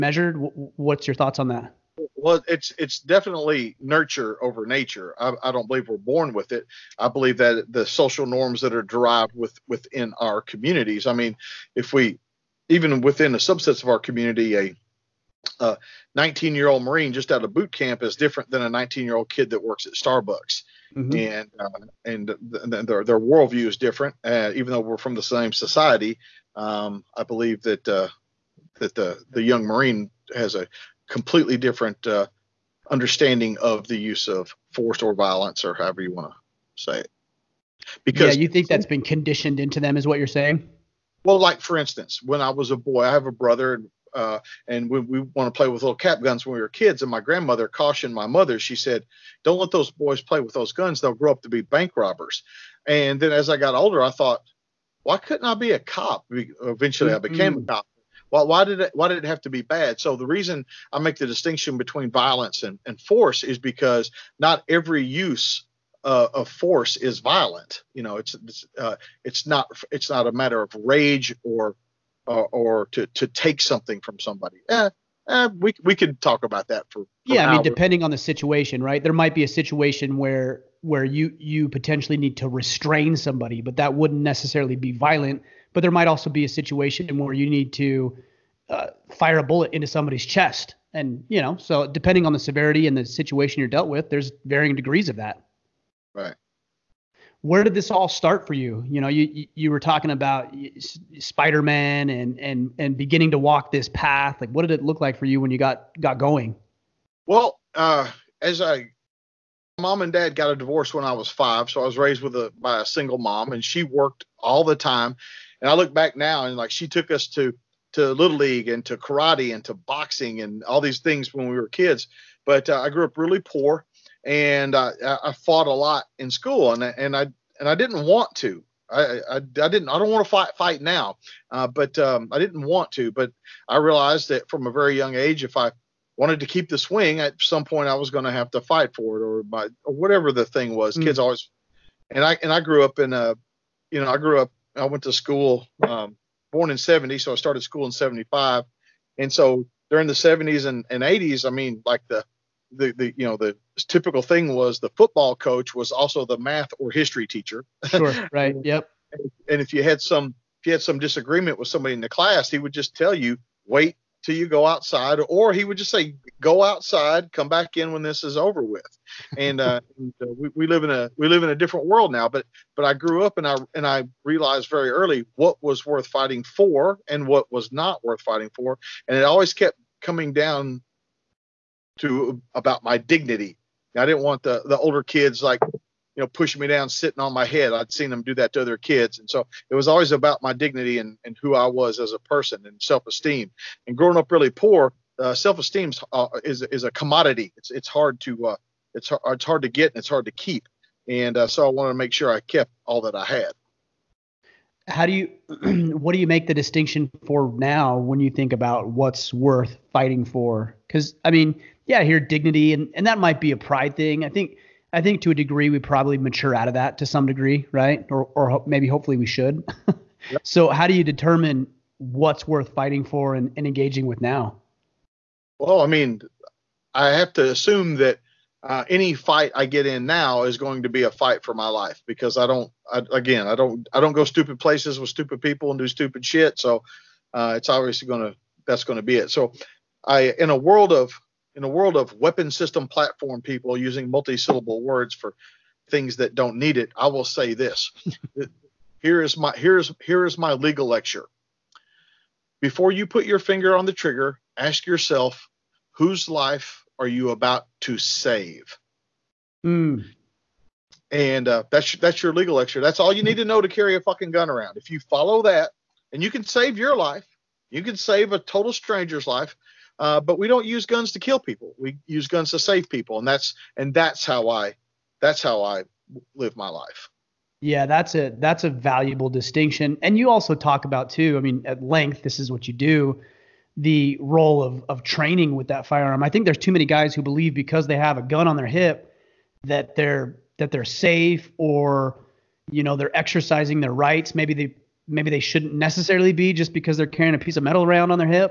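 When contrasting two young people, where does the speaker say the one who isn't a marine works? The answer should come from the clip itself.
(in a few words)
Starbucks.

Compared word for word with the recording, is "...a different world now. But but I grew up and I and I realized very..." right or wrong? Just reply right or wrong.
right.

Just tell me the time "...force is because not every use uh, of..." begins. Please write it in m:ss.
1:03.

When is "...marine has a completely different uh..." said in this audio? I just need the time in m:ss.
0:29.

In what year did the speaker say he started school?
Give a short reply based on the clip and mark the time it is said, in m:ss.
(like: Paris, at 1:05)
1975, at 2:27.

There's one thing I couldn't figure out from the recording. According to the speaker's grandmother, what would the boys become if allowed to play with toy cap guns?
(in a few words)
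Bank robbers.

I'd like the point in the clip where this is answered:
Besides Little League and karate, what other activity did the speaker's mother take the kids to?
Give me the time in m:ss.
1:59.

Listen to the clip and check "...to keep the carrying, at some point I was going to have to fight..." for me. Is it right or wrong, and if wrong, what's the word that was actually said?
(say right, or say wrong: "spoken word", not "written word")
wrong: "swing", not "carrying".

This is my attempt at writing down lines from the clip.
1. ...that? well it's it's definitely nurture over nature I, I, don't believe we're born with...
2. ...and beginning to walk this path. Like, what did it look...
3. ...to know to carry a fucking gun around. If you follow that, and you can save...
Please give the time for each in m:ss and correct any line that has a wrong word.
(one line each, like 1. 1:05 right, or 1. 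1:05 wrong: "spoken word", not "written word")
1. 0:01 right
2. 1:42 right
3. 4:23 right.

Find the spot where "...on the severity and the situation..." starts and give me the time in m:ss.
1:32.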